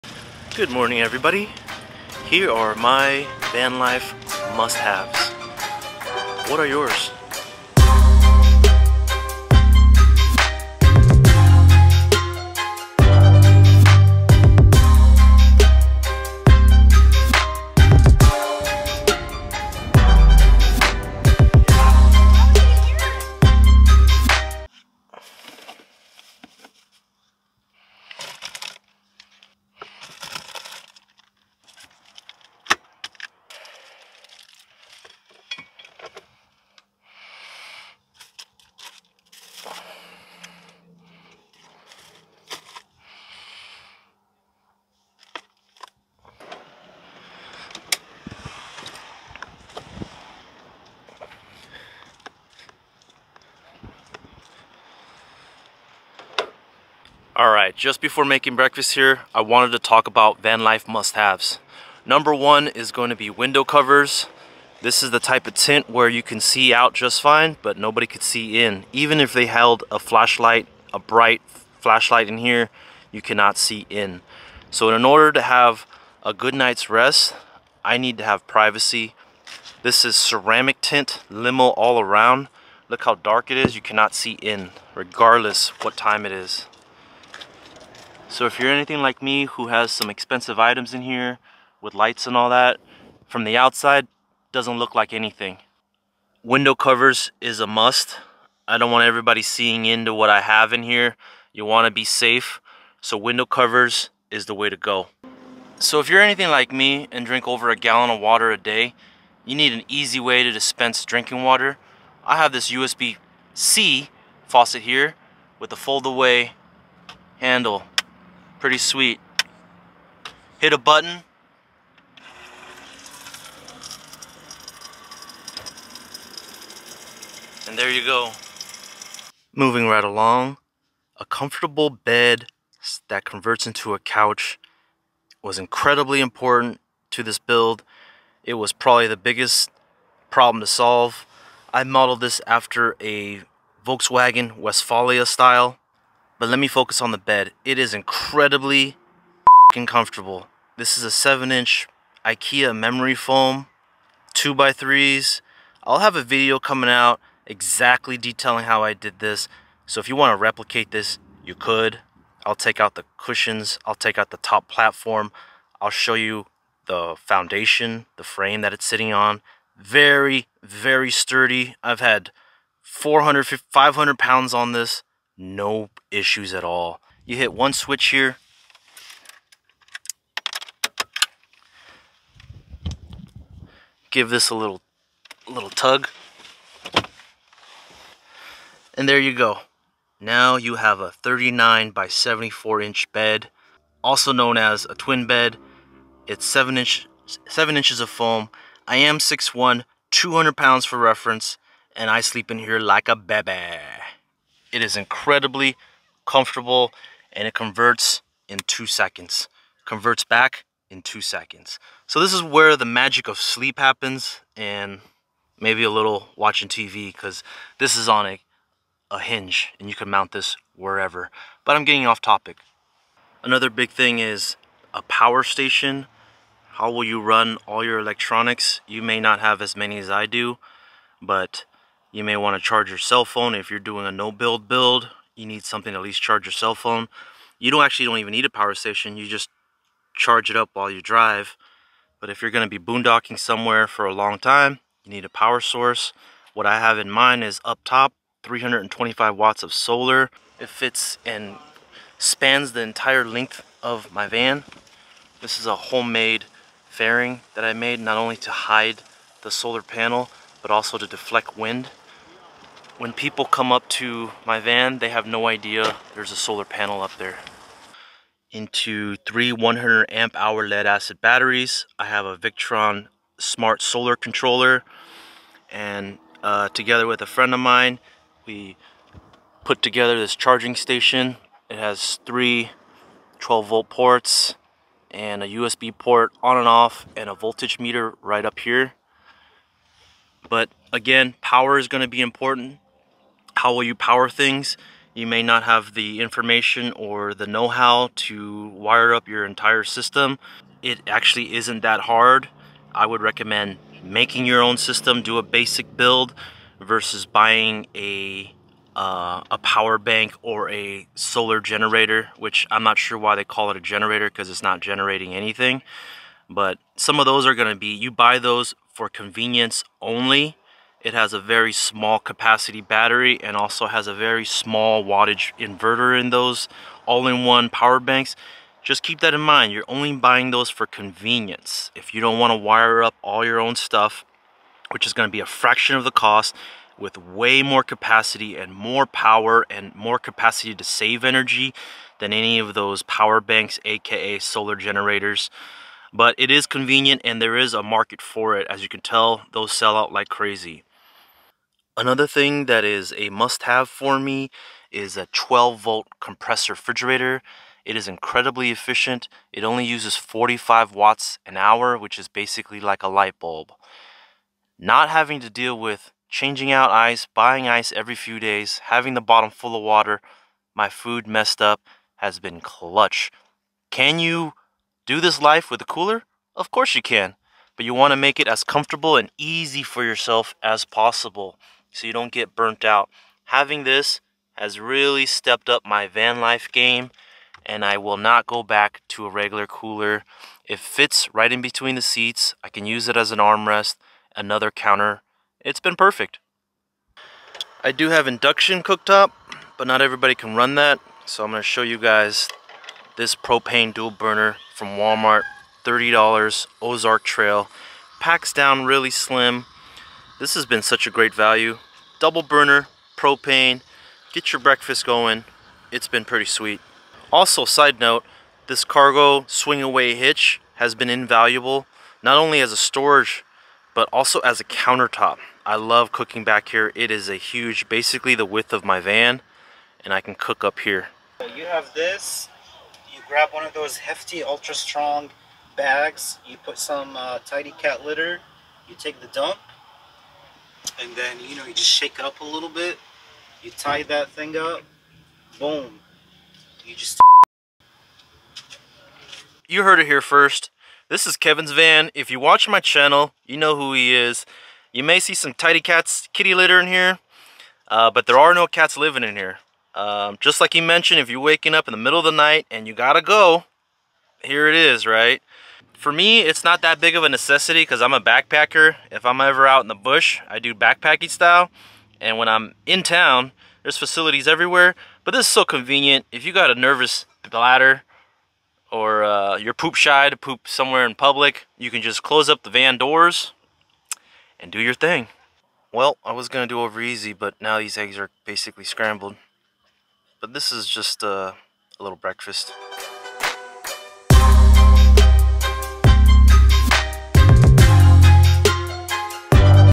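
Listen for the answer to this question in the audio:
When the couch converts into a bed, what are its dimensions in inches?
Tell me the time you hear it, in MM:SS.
03:11.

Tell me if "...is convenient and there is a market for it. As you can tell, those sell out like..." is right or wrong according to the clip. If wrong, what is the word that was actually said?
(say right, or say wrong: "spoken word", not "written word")
right.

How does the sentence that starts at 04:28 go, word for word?
Into three 100 amp hour lead acid batteries.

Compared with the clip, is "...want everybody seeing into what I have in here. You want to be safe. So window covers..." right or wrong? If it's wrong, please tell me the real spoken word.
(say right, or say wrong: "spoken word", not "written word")
right.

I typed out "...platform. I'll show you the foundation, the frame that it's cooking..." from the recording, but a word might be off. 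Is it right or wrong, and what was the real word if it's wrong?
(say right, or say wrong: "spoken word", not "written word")
wrong: "sitting", not "cooking".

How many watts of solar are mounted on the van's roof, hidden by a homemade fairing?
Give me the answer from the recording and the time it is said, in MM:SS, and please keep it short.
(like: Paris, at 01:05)
325 watts, at 04:08.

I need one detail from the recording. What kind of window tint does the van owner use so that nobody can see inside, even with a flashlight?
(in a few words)
ceramic tint.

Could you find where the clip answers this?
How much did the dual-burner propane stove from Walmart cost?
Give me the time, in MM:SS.
06:45.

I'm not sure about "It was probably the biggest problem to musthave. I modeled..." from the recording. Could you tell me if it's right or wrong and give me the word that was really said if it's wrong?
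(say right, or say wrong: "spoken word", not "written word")
wrong: "solve", not "musthave".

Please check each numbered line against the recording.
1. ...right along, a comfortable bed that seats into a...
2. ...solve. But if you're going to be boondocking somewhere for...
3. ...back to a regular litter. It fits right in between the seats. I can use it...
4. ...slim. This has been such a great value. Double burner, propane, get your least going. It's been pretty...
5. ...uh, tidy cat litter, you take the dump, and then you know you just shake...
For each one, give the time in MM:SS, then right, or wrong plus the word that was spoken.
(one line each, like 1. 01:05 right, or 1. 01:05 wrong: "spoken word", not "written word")
1. 02:09 wrong: "converts", not "seats"
2. 04:01 wrong: "drive", not "solve"
3. 06:28 wrong: "cooler", not "litter"
4. 06:49 wrong: "breakfast", not "least"
5. 07:17 right.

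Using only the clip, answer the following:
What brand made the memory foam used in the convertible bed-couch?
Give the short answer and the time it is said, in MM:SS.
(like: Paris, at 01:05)
IKEA, at 02:32.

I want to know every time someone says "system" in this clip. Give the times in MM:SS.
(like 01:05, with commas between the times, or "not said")
04:59, 05:04.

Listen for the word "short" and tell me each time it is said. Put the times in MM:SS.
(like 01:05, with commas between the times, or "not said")
not said.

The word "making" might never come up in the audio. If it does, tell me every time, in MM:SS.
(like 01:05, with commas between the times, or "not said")
00:58, 05:04.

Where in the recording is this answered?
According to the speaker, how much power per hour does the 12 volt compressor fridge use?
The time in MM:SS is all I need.
06:00.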